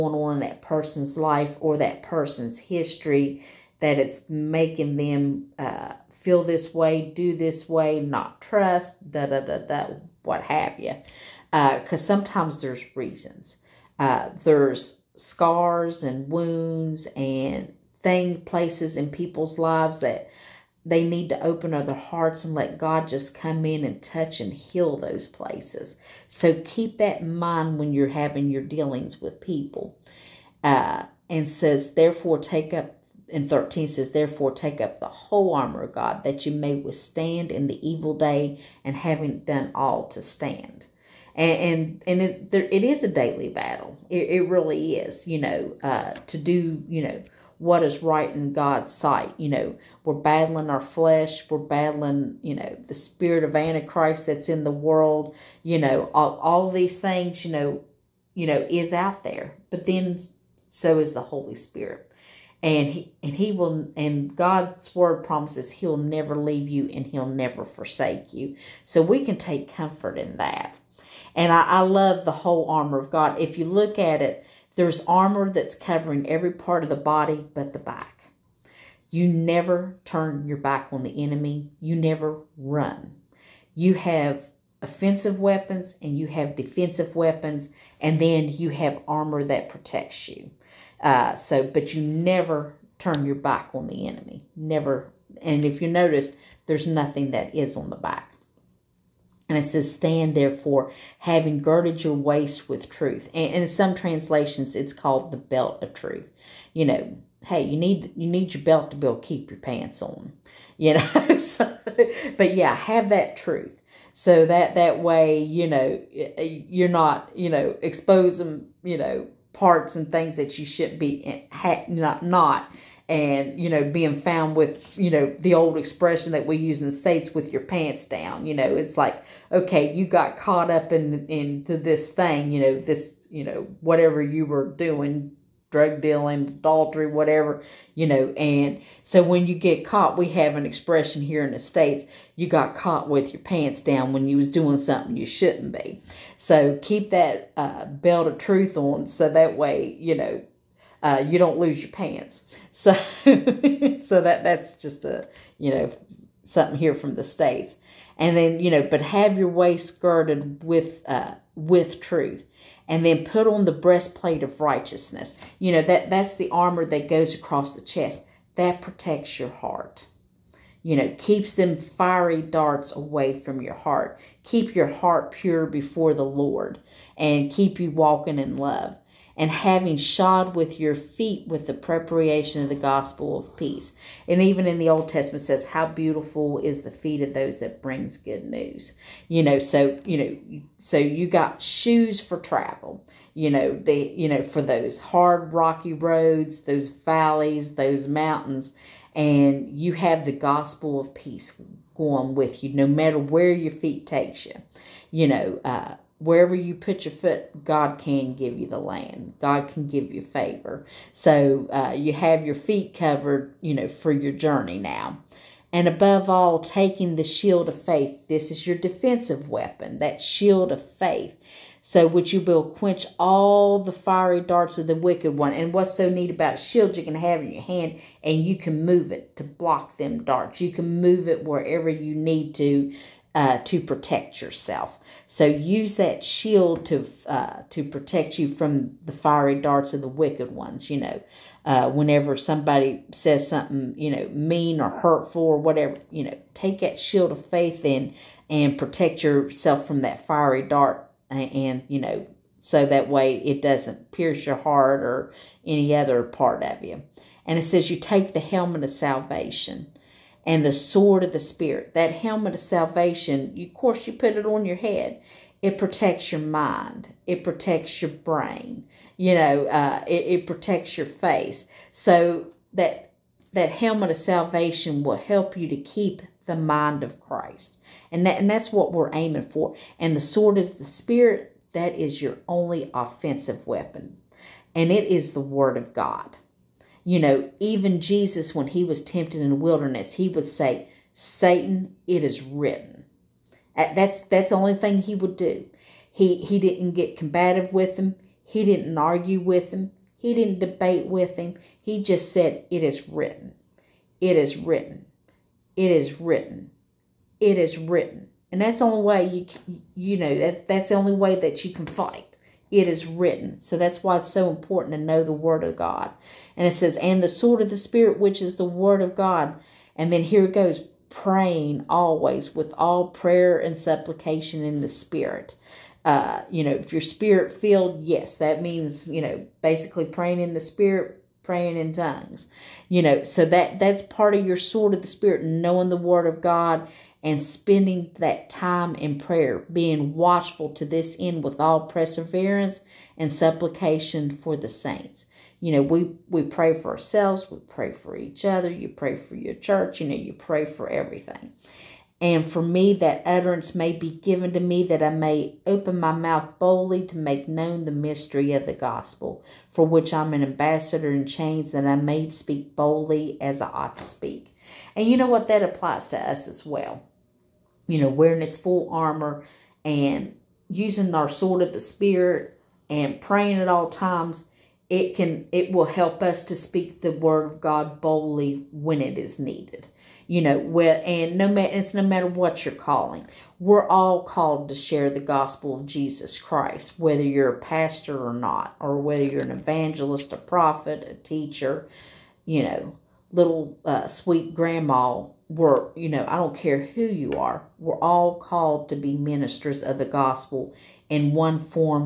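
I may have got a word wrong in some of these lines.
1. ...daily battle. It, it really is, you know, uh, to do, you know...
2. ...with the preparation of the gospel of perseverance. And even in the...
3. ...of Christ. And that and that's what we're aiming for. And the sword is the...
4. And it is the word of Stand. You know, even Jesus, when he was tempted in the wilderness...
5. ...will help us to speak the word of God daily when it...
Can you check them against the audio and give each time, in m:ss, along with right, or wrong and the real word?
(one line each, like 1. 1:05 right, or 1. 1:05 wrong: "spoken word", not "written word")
1. 0:43 right
2. 3:01 wrong: "peace", not "perseverance"
3. 4:37 right
4. 4:44 wrong: "God", not "Stand"
5. 6:15 wrong: "boldly", not "daily".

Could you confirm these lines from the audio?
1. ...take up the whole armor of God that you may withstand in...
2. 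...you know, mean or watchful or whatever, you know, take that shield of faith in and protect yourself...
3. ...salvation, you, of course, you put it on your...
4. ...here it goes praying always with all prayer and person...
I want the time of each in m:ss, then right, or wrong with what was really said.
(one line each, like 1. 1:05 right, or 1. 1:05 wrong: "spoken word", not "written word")
1. 0:34 right
2. 4:03 wrong: "hurtful", not "watchful"
3. 4:22 right
4. 5:20 wrong: "supplication", not "person".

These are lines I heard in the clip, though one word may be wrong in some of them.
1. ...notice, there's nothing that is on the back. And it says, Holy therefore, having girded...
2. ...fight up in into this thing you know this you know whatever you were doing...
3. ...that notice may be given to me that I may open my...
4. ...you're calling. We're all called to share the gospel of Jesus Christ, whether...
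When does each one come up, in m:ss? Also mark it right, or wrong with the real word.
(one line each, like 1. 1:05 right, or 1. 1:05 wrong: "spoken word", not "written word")
1. 1:35 wrong: "Stand", not "Holy"
2. 2:10 wrong: "caught", not "fight"
3. 5:52 wrong: "utterance", not "notice"
4. 6:22 right.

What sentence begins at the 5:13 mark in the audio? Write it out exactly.
So that's why it's so important to know the Word of God.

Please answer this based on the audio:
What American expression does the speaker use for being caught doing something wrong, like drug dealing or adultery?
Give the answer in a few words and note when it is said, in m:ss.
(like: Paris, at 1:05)
caught with your pants down, at 2:22.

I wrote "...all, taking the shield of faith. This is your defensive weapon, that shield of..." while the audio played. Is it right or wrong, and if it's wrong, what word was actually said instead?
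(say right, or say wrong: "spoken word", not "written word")
right.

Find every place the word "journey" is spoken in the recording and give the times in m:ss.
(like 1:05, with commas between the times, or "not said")
3:34.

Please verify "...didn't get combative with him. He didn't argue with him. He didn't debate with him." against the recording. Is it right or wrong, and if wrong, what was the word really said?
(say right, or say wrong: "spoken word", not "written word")
right.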